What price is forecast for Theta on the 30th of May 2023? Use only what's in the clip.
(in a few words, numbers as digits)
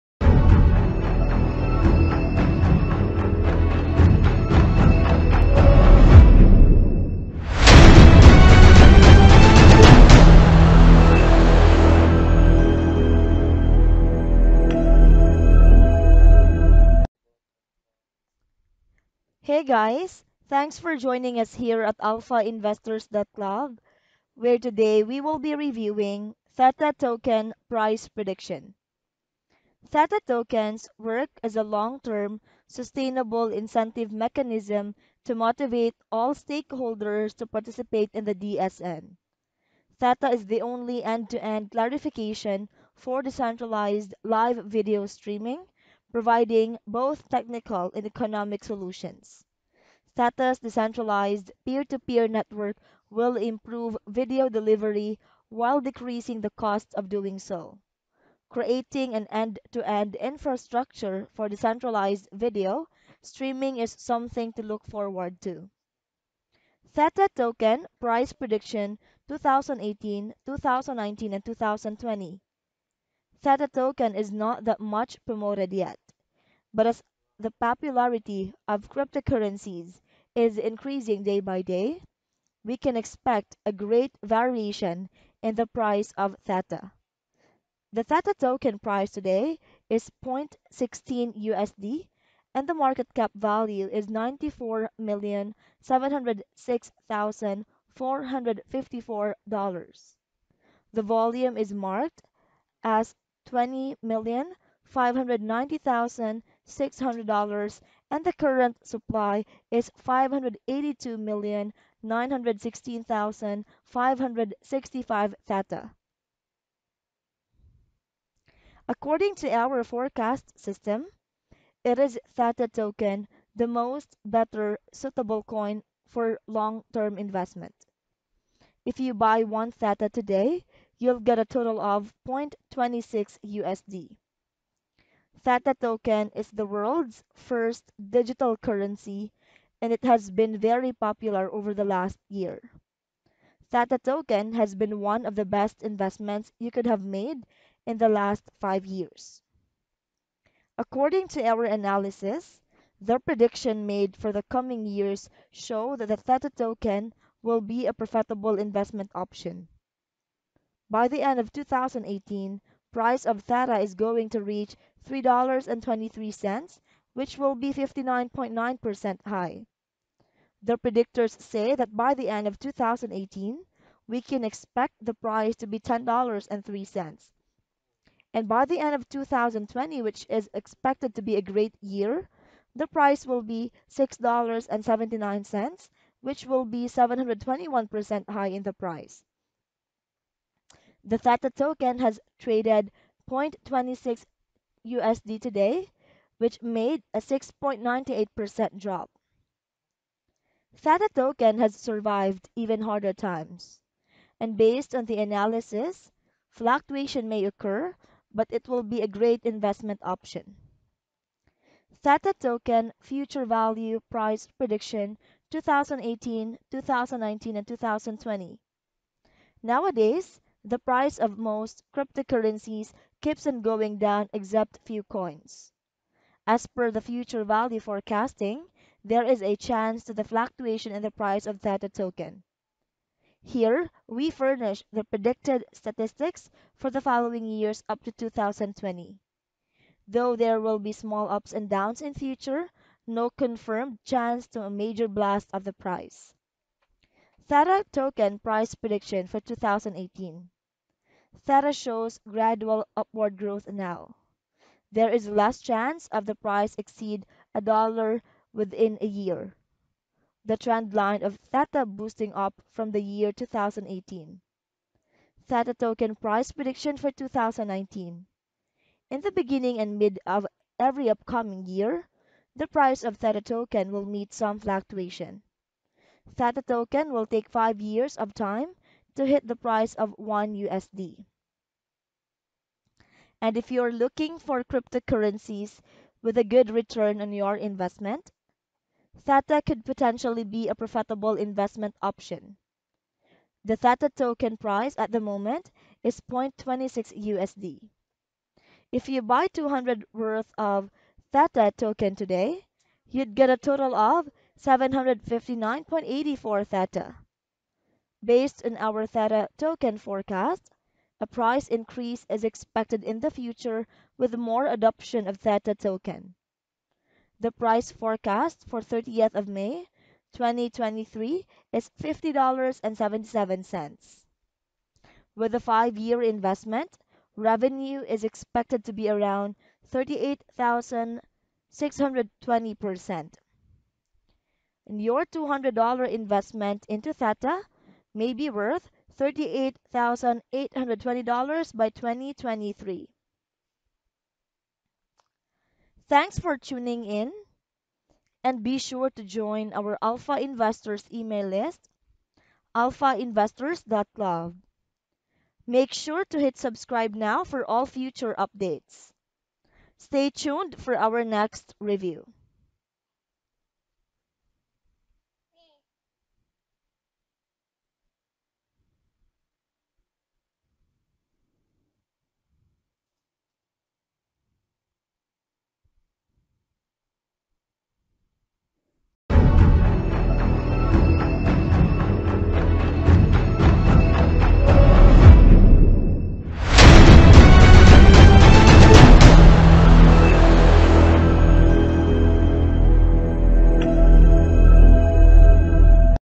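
$50.77.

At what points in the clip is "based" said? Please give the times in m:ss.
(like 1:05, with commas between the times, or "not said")
3:24, 5:08.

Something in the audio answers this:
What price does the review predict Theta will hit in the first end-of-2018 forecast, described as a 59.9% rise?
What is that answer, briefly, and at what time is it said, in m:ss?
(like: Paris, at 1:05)
$3.23, at 2:45.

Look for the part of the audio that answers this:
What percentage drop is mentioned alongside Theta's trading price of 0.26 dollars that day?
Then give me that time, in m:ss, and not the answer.
3:17.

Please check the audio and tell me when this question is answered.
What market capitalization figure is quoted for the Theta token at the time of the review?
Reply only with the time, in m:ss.
1:34.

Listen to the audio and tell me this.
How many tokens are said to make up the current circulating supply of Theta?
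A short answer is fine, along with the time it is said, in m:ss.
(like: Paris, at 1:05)
582,916,565, at 1:50.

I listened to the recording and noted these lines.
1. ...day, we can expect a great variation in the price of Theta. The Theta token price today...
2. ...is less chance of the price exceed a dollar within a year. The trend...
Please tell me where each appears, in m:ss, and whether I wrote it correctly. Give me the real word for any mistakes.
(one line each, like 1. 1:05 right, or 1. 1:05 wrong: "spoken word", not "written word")
1. 1:21 right
2. 4:15 right.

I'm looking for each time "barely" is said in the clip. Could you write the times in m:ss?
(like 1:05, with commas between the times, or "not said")
not said.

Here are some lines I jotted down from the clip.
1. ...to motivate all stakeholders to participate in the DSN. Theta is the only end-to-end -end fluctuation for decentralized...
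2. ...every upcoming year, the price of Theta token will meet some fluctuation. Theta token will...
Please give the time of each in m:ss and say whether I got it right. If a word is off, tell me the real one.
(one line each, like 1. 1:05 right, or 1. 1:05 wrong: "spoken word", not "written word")
1. 0:35 wrong: "clarification", not "fluctuation"
2. 4:30 right.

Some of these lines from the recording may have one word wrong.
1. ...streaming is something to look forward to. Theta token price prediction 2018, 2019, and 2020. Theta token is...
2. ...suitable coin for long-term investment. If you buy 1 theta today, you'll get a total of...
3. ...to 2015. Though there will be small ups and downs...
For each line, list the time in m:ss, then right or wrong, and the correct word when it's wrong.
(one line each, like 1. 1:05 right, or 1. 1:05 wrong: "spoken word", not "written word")
1. 1:03 right
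2. 2:04 right
3. 3:58 wrong: "2020", not "2015".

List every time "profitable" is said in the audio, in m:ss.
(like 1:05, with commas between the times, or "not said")
2:37, 4:50.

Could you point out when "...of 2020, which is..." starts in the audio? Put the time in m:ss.
2:58.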